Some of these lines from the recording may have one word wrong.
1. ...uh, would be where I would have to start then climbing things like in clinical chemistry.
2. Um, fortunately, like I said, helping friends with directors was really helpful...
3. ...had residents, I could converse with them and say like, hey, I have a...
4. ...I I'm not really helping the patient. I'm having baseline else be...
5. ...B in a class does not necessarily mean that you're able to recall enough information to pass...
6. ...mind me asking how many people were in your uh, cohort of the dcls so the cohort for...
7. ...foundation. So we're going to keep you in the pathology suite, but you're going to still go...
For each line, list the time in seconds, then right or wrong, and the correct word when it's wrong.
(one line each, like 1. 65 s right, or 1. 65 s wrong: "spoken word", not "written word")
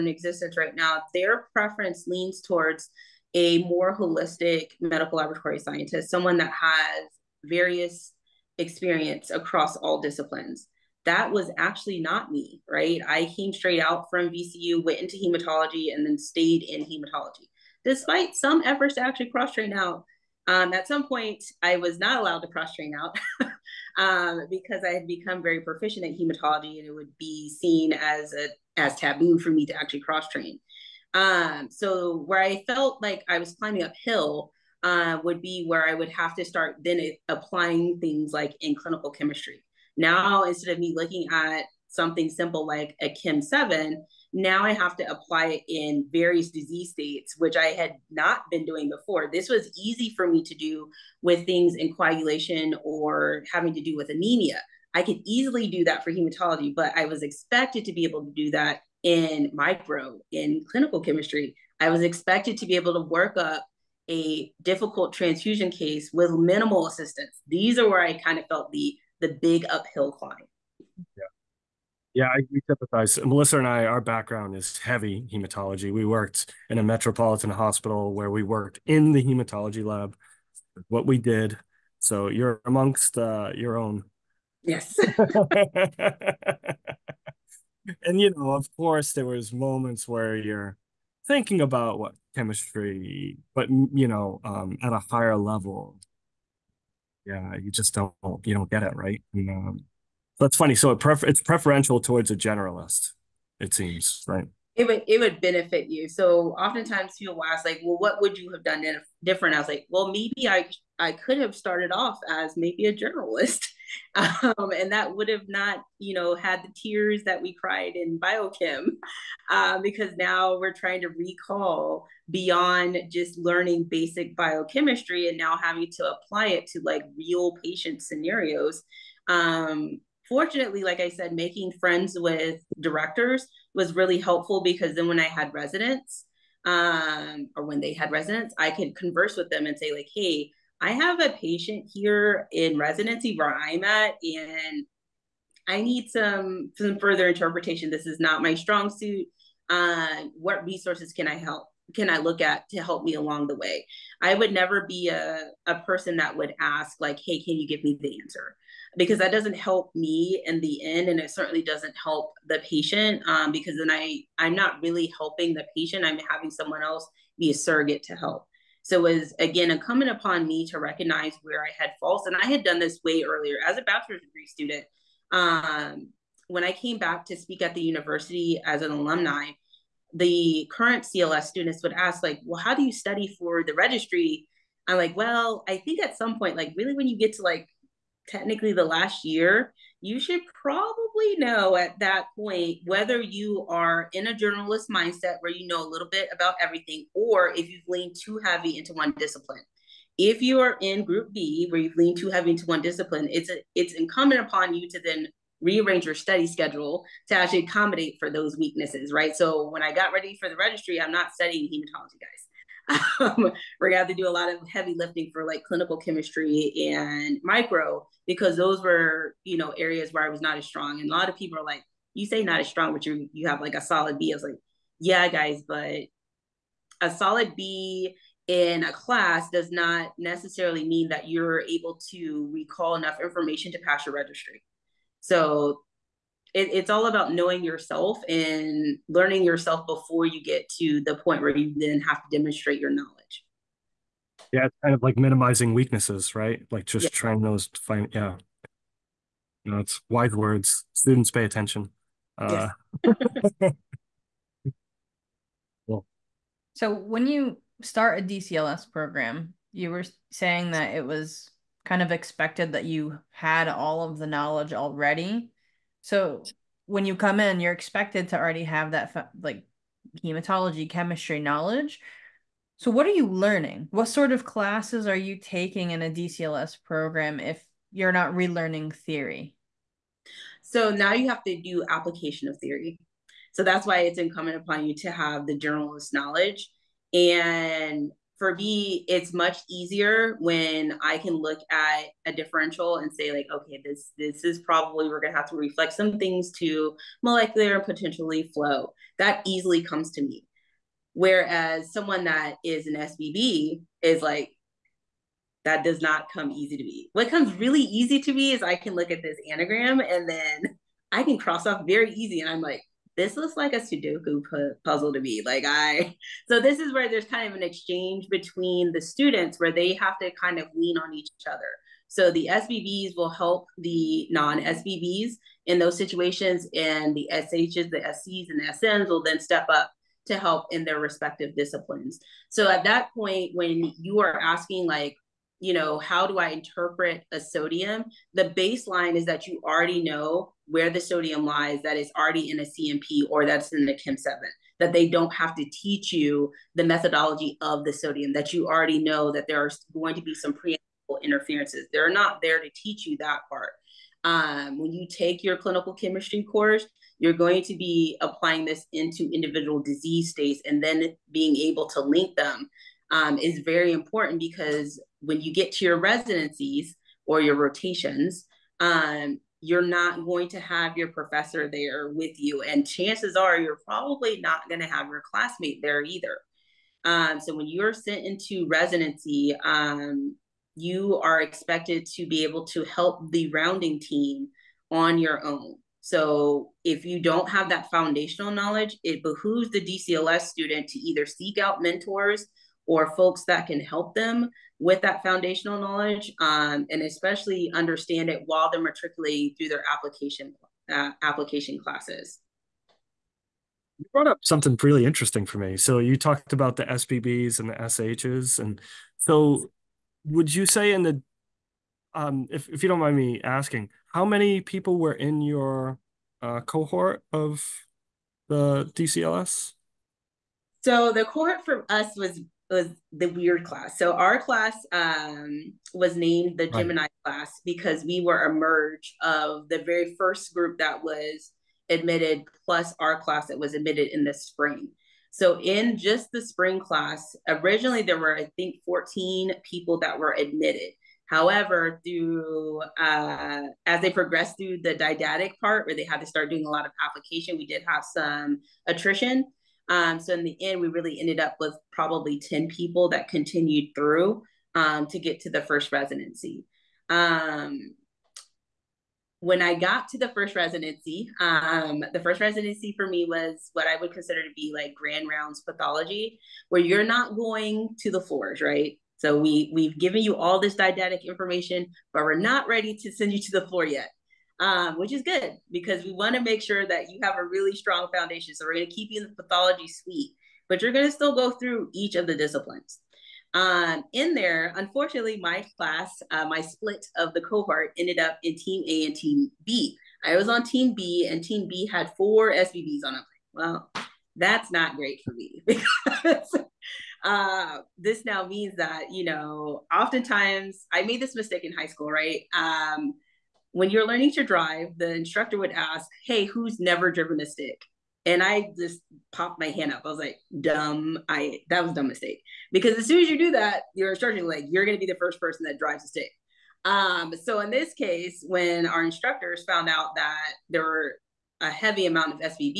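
1. 34 s wrong: "applying", not "climbing"
2. 129 s wrong: "making", not "helping"
3. 137 s right
4. 163 s wrong: "someone", not "baseline"
5. 227 s right
6. 413 s right
7. 478 s right.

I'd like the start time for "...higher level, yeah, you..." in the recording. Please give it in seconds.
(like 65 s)
95 s.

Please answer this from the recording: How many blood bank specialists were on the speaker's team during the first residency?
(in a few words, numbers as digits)
4.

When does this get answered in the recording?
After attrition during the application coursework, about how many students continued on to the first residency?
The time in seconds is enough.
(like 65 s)
452 s.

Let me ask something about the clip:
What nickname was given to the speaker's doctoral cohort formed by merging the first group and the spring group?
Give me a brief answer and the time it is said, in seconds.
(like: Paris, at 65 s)
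Gemini, at 426 s.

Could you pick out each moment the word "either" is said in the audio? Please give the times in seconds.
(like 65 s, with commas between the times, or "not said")
376 s, 390 s.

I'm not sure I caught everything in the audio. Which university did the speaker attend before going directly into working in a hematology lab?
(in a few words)
VCU.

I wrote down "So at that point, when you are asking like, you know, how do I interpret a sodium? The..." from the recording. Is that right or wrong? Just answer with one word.
right.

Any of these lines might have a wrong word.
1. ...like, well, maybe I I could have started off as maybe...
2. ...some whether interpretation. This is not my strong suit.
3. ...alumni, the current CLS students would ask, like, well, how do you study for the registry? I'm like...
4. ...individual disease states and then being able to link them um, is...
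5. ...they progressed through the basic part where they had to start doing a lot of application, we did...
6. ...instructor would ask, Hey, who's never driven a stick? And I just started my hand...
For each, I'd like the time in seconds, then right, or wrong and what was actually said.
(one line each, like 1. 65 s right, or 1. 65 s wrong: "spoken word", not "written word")
1. 109 s right
2. 146 s wrong: "further", not "whether"
3. 178 s right
4. 359 s right
5. 444 s wrong: "didactic", not "basic"
6. 505 s wrong: "popped", not "started".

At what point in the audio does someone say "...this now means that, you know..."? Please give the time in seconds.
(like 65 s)
497 s.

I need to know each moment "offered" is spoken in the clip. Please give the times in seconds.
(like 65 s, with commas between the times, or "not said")
not said.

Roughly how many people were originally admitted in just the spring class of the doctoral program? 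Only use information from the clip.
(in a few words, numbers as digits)
14.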